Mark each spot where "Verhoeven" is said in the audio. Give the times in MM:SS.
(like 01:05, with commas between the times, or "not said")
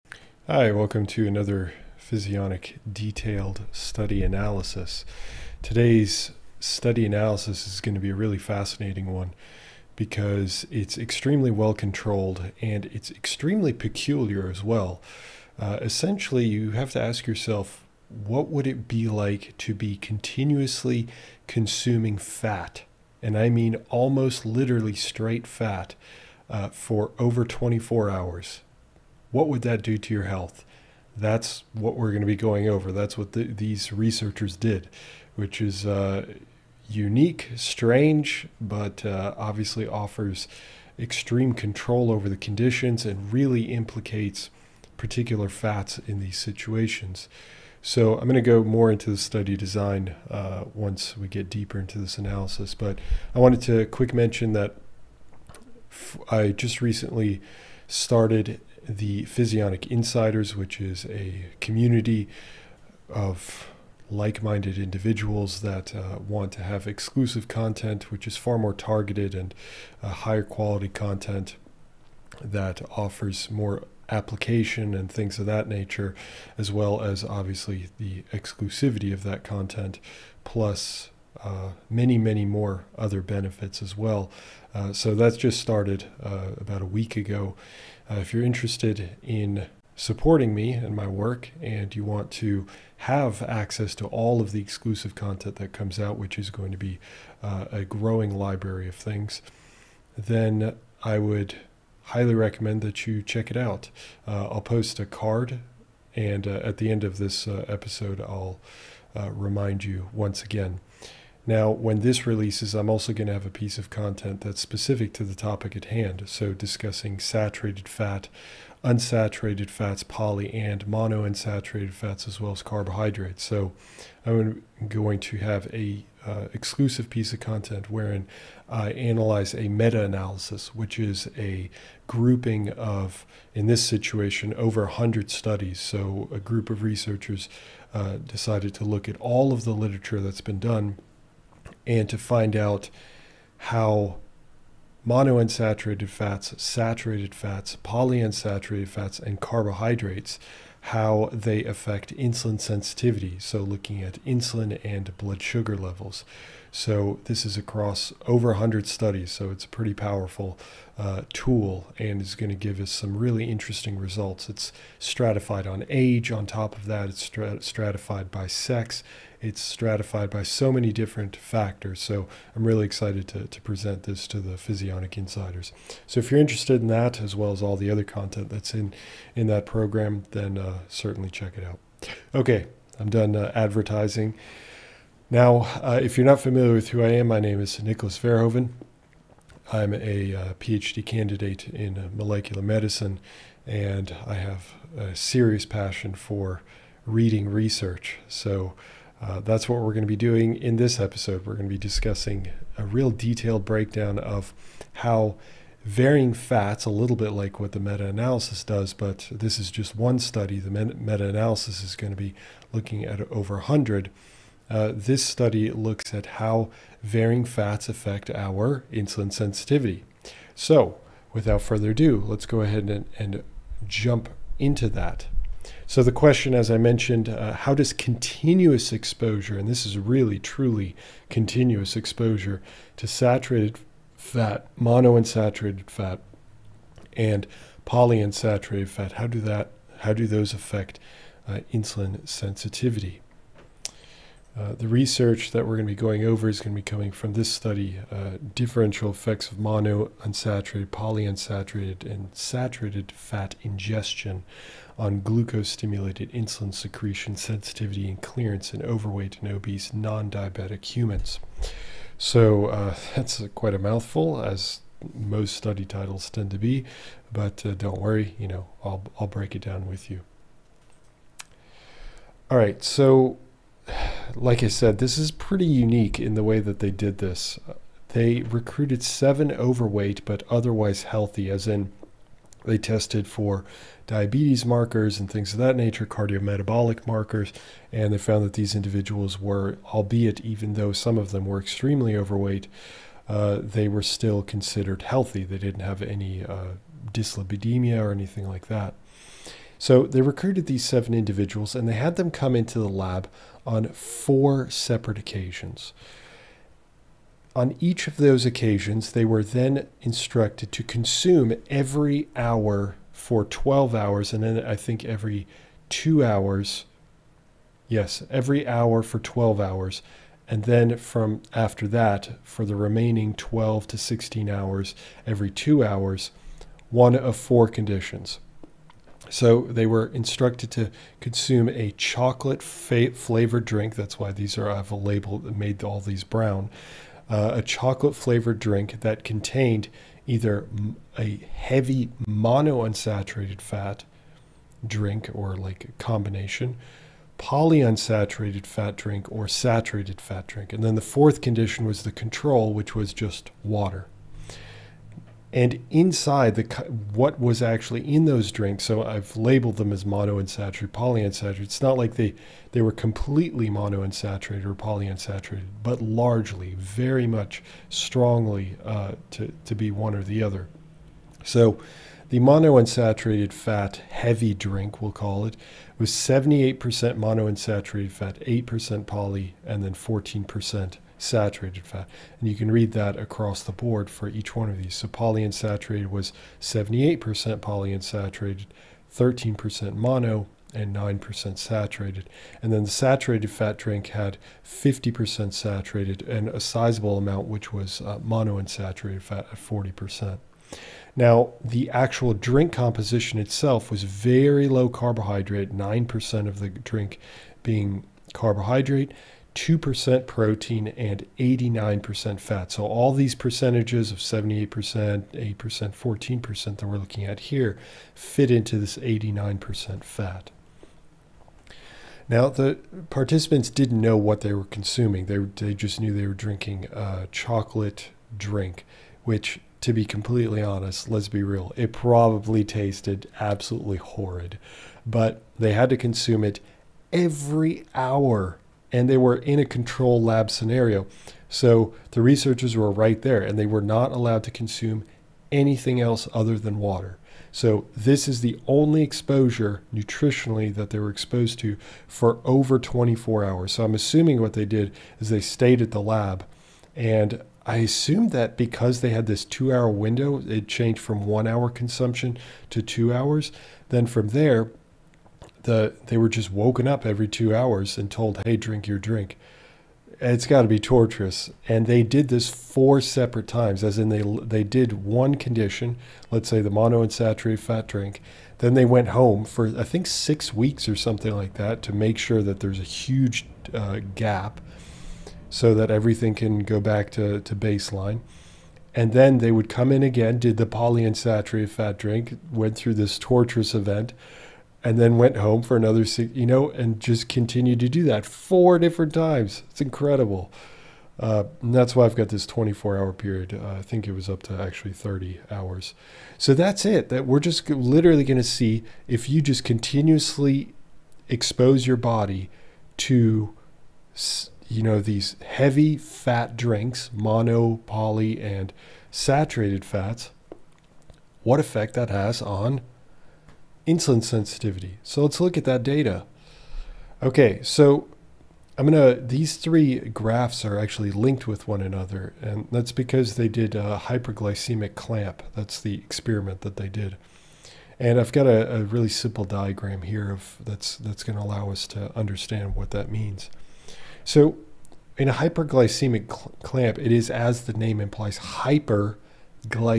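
03:08.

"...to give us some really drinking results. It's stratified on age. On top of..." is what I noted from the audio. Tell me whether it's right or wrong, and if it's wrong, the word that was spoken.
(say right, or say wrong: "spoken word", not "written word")
wrong: "interesting", not "drinking".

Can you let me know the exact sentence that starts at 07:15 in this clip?
But they had to consume it every hour and they were in a control lab scenario.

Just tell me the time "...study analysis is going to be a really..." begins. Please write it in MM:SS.
00:06.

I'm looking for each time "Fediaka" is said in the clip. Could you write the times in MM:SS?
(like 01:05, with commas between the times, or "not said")
not said.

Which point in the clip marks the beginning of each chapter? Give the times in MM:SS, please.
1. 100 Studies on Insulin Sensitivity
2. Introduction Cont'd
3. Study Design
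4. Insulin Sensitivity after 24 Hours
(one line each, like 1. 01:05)
1. 00:51
2. 03:00
3. 04:32
4. 08:45.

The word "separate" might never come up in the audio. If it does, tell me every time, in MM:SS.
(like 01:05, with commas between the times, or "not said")
05:04, 07:53.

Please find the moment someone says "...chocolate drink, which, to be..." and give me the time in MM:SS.
07:07.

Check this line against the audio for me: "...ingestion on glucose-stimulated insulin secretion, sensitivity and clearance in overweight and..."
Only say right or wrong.
right.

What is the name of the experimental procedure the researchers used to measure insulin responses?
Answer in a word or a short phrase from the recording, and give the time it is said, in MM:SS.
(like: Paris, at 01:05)
hyperglycemic clamp, at 08:54.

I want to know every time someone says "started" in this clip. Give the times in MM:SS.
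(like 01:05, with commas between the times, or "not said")
00:57, 01:25.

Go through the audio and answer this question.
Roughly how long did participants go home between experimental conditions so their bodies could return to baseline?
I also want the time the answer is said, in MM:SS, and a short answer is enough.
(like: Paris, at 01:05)
6 weeks, at 08:00.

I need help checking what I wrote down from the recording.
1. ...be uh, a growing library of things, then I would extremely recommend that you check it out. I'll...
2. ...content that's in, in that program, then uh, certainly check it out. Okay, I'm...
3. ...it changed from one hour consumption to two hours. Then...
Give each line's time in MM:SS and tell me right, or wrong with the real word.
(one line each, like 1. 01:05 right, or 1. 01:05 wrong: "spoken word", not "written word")
1. 01:36 wrong: "highly", not "extremely"
2. 02:58 right
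3. 07:40 right.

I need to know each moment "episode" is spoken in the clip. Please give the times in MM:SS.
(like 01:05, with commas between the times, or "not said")
01:47, 03:20.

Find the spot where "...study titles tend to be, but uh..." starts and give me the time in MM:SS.
04:25.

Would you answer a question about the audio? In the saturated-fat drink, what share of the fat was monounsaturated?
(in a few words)
40%.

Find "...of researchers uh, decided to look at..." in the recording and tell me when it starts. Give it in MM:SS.
02:16.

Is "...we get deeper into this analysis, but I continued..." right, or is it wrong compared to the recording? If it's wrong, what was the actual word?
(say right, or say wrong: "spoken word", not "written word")
wrong: "wanted", not "continued".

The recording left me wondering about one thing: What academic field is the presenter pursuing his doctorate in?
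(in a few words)
molecular medicine.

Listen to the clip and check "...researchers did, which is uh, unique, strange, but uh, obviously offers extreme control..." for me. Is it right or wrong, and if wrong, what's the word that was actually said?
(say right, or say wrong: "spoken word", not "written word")
right.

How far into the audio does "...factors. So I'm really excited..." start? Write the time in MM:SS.
02:51.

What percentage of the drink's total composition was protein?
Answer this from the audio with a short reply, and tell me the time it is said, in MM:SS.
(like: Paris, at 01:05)
2%, at 06:49.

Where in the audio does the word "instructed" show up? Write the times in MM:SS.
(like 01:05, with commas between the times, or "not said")
05:10, 05:30.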